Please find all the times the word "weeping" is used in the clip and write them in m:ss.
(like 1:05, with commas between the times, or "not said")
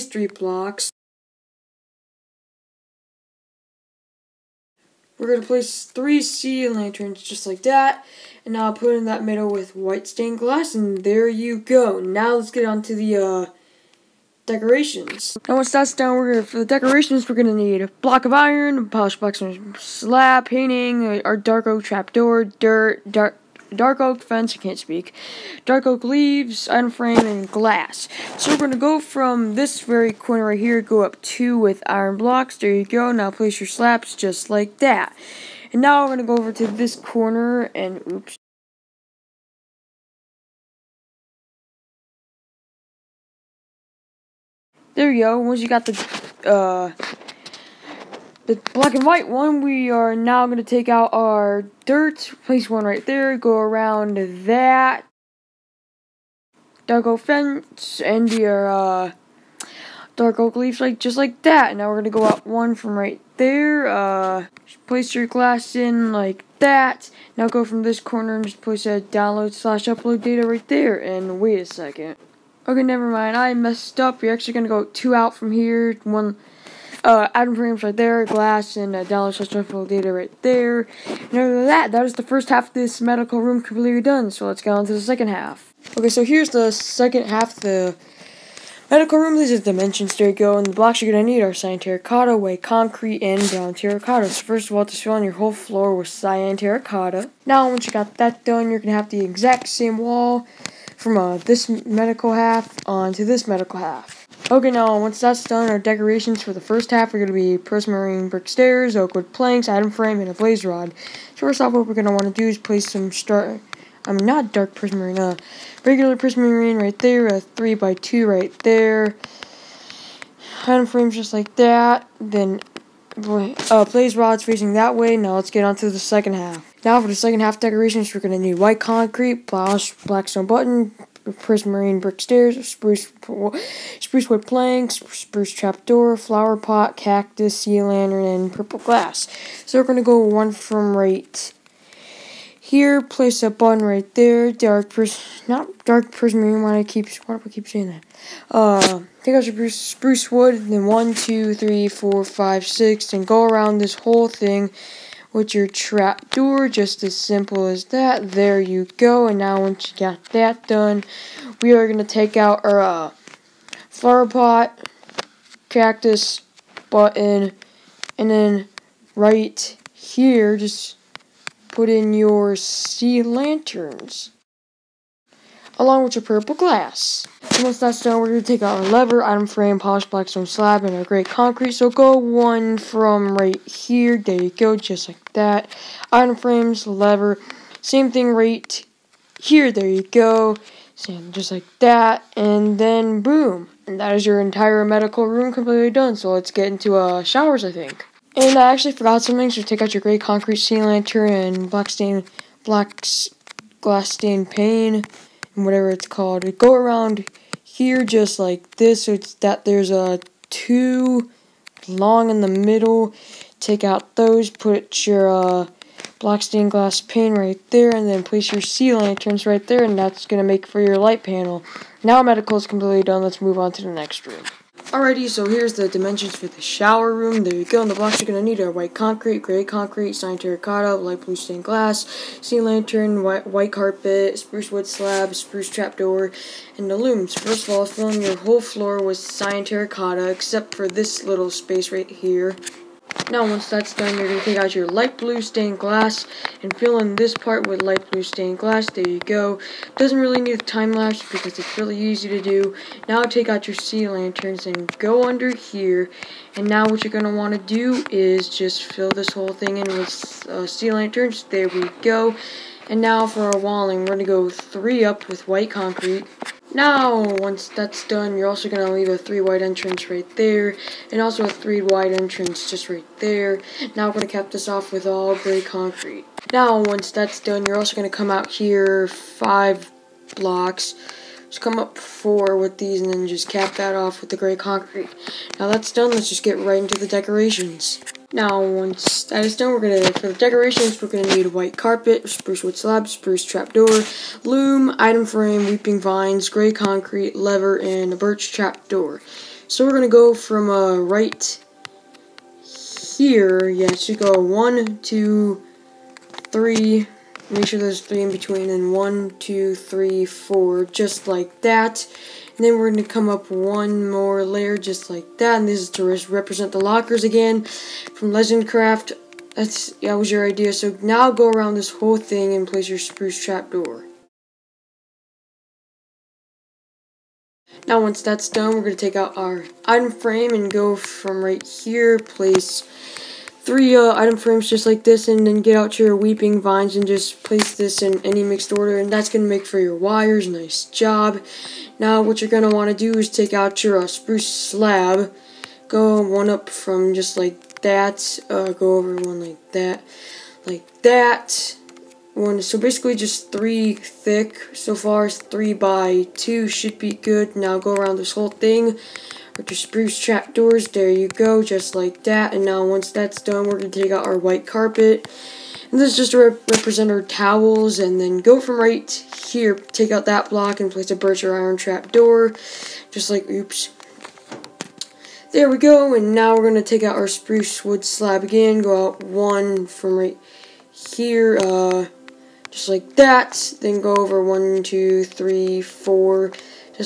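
4:55, 5:36.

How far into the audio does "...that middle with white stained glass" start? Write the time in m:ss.
0:09.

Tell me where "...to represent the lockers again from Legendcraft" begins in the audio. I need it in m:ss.
5:15.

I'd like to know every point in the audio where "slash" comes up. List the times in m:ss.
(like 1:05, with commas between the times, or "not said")
1:09.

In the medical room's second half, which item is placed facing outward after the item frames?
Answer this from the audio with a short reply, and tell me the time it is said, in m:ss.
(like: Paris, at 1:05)
Blaze rods, at 2:03.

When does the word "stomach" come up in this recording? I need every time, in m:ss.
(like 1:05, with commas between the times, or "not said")
not said.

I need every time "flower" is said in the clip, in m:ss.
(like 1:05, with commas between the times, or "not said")
2:16, 2:43.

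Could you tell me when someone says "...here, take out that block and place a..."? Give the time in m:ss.
6:09.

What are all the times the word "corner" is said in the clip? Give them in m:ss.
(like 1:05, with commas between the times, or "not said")
0:30, 0:36, 1:07.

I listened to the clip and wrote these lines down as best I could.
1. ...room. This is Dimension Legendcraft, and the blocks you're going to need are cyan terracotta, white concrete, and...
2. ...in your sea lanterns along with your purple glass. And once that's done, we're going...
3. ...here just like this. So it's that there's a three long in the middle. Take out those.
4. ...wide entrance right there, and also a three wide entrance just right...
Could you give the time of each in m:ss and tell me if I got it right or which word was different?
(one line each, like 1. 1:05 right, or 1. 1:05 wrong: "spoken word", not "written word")
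1. 1:29 wrong: "Stereo", not "Legendcraft"
2. 2:51 right
3. 3:27 wrong: "two", not "three"
4. 4:29 right.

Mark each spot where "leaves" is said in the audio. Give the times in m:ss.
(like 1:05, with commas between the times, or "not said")
0:26, 1:00, 4:28.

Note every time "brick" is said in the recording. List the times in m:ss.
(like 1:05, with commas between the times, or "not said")
1:48, 2:11.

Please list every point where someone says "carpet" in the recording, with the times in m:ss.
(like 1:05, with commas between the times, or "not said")
3:53, 4:51, 6:04.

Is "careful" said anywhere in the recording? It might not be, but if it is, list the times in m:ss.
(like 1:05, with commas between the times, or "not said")
not said.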